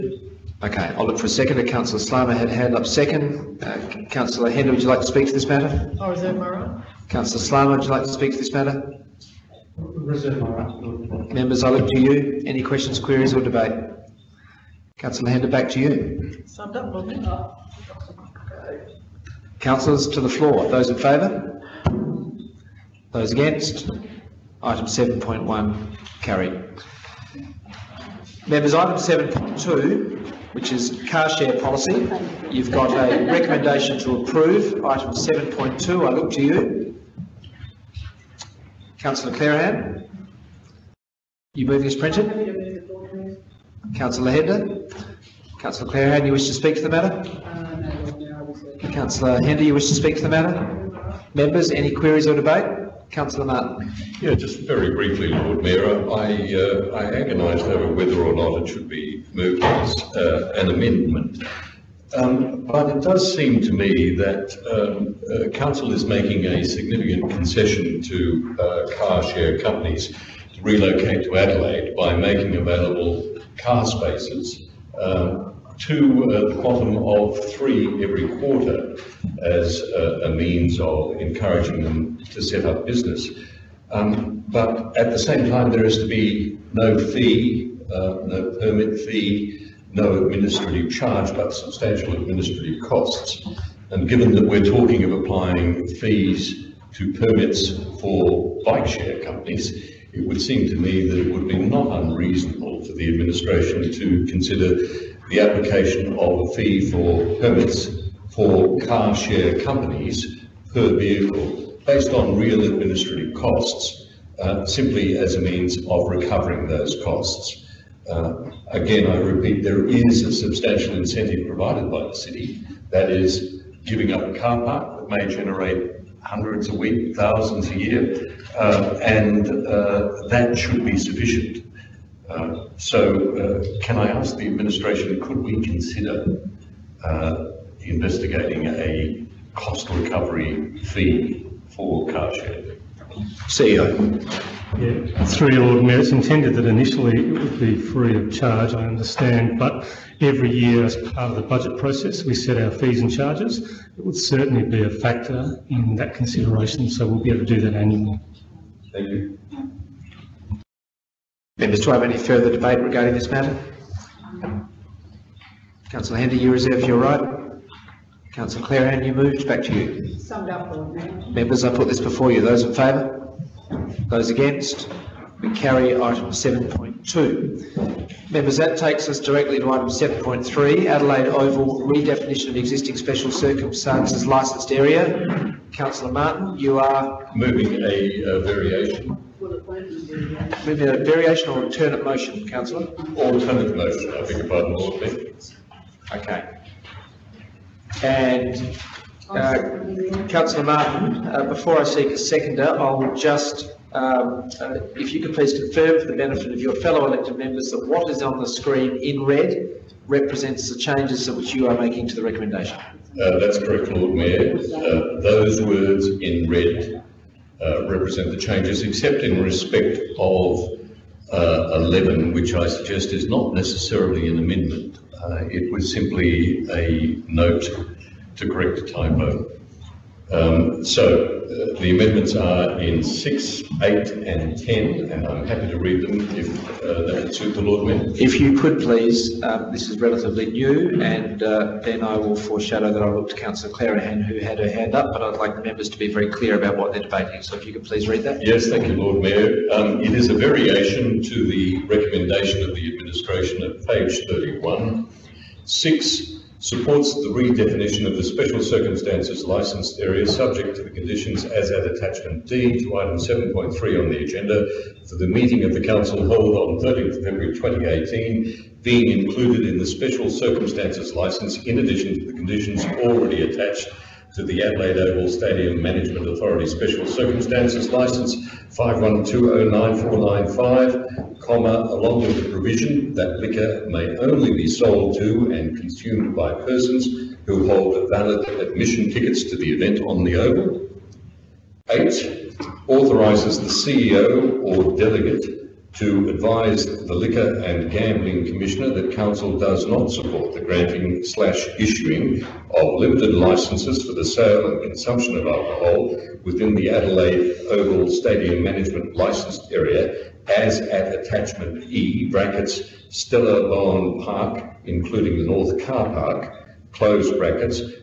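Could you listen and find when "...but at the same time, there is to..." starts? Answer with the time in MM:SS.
01:24.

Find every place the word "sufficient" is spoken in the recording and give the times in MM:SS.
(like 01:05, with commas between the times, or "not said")
02:10.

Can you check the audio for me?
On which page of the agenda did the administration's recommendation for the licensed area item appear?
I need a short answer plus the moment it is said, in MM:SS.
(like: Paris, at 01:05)
31, at 04:13.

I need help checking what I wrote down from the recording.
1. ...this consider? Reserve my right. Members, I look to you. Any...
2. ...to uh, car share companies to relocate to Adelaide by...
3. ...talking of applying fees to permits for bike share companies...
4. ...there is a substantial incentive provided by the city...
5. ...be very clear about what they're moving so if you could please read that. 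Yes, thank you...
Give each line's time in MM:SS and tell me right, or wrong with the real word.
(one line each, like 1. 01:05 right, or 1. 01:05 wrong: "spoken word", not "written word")
1. 00:08 wrong: "matter", not "consider"
2. 01:08 right
3. 01:34 right
4. 01:59 right
5. 04:05 wrong: "debating", not "moving".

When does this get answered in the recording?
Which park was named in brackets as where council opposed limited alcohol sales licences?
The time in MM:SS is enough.
05:13.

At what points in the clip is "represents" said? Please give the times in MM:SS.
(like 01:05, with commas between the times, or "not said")
03:30, 03:37.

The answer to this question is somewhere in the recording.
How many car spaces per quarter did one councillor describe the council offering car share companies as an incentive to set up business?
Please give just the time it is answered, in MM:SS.
01:15.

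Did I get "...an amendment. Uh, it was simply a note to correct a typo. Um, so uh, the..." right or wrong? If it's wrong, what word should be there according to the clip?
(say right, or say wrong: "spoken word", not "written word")
right.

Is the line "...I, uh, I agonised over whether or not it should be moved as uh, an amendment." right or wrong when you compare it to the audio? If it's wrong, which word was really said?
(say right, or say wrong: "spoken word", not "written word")
right.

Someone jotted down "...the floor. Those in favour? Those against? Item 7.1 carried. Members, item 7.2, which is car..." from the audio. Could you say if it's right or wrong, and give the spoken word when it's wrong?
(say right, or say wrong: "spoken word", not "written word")
right.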